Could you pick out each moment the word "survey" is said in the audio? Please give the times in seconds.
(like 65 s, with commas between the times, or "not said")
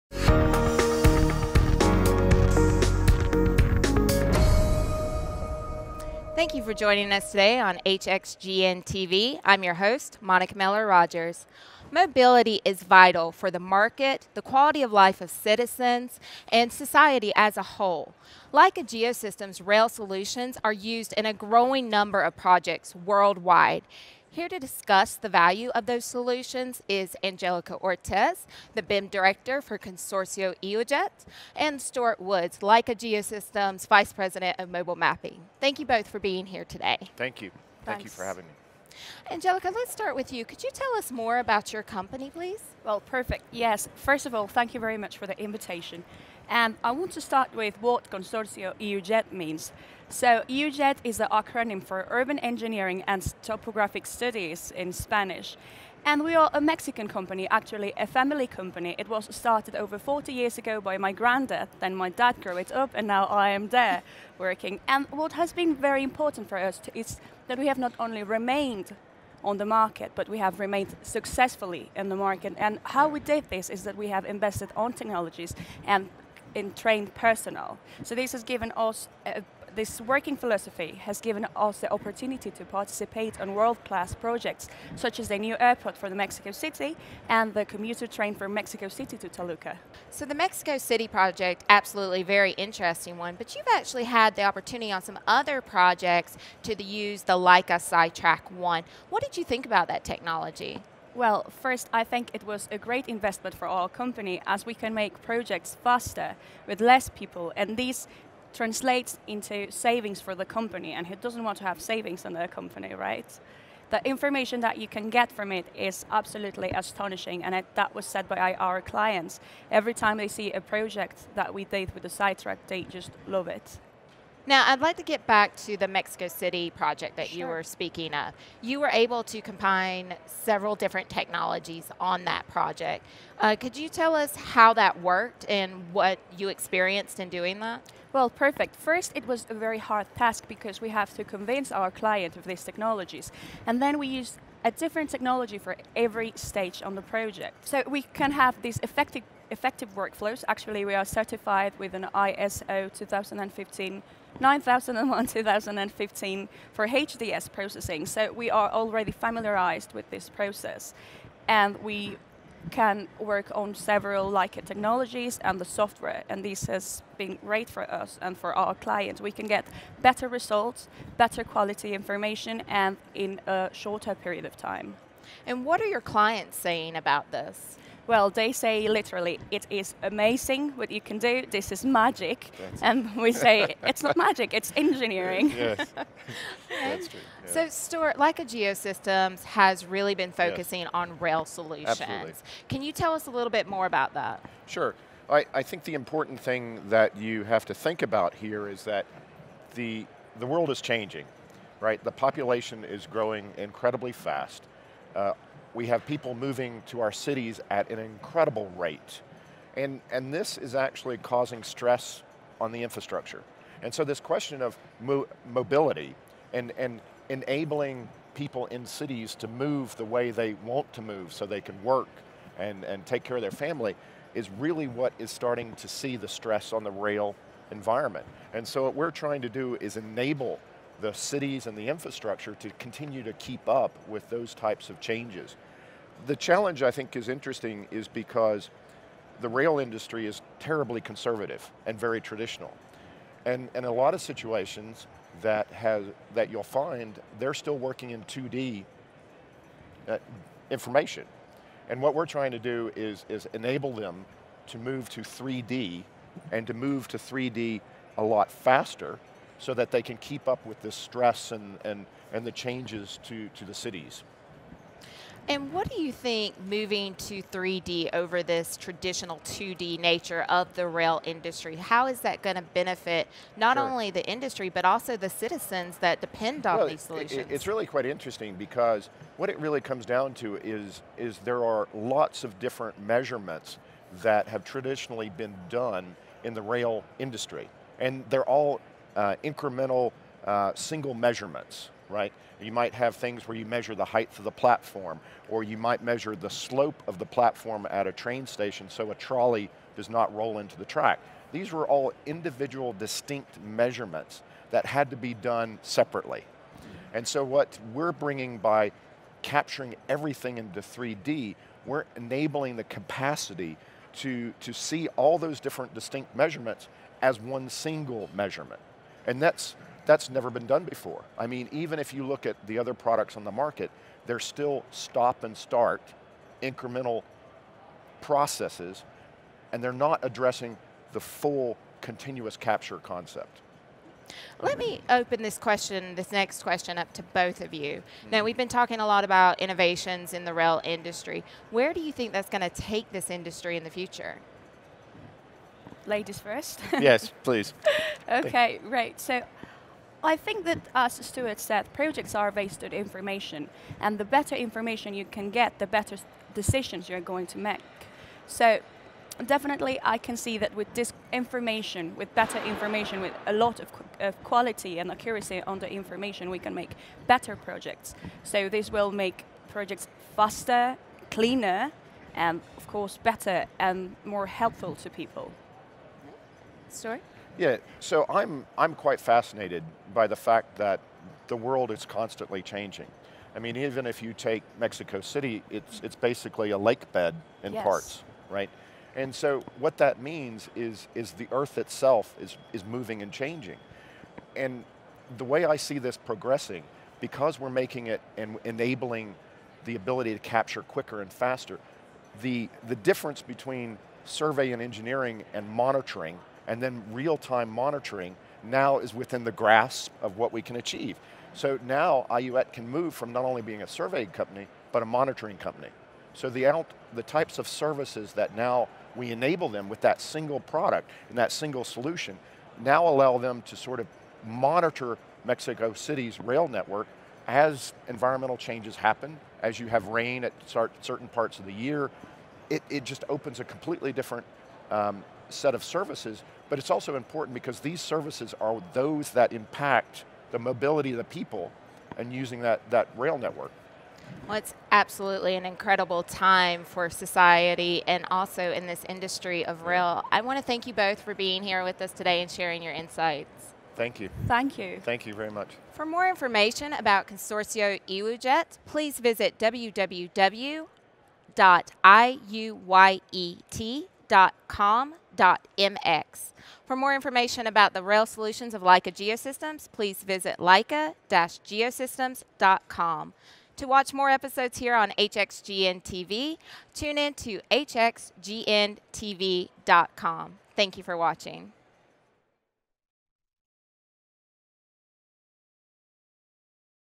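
404 s, 413 s.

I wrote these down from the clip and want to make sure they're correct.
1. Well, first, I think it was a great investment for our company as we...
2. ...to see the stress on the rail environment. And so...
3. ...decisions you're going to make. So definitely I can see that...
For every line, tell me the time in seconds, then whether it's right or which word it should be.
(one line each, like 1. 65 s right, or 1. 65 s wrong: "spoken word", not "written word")
1. 101 s right
2. 225 s right
3. 356 s right.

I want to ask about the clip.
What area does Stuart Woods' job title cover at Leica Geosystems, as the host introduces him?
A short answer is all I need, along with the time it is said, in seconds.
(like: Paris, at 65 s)
Mobile Mapping, at 34 s.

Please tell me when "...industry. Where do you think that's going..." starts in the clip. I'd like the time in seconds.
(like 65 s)
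340 s.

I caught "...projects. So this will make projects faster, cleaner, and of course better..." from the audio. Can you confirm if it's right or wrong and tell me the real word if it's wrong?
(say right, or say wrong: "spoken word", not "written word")
right.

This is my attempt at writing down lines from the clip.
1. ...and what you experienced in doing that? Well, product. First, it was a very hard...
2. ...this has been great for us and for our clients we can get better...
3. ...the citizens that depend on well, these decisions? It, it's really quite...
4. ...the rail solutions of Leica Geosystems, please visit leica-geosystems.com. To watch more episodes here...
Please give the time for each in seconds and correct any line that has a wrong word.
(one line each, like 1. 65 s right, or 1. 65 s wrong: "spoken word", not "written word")
1. 135 s wrong: "perfect", not "product"
2. 166 s right
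3. 275 s wrong: "solutions", not "decisions"
4. 467 s right.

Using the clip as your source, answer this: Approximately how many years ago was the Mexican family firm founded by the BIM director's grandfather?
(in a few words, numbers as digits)
over 40 years.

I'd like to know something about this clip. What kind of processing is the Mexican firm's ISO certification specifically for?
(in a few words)
HDS processing.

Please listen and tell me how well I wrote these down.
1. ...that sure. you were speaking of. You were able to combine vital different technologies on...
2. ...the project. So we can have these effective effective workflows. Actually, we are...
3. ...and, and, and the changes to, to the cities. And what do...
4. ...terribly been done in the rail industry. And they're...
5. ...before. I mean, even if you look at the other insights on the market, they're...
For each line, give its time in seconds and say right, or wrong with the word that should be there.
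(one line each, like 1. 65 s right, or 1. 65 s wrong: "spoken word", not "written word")
1. 127 s wrong: "several", not "vital"
2. 146 s right
3. 261 s right
4. 284 s wrong: "traditionally", not "terribly"
5. 320 s wrong: "products", not "insights".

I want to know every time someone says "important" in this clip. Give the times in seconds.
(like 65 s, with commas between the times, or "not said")
66 s, 195 s, 437 s.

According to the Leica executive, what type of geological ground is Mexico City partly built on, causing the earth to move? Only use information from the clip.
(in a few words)
a lake bed.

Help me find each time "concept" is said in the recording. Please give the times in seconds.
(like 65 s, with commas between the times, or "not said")
332 s.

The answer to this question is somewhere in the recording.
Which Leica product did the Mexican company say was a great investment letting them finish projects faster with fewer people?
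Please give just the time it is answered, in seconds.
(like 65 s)
97 s.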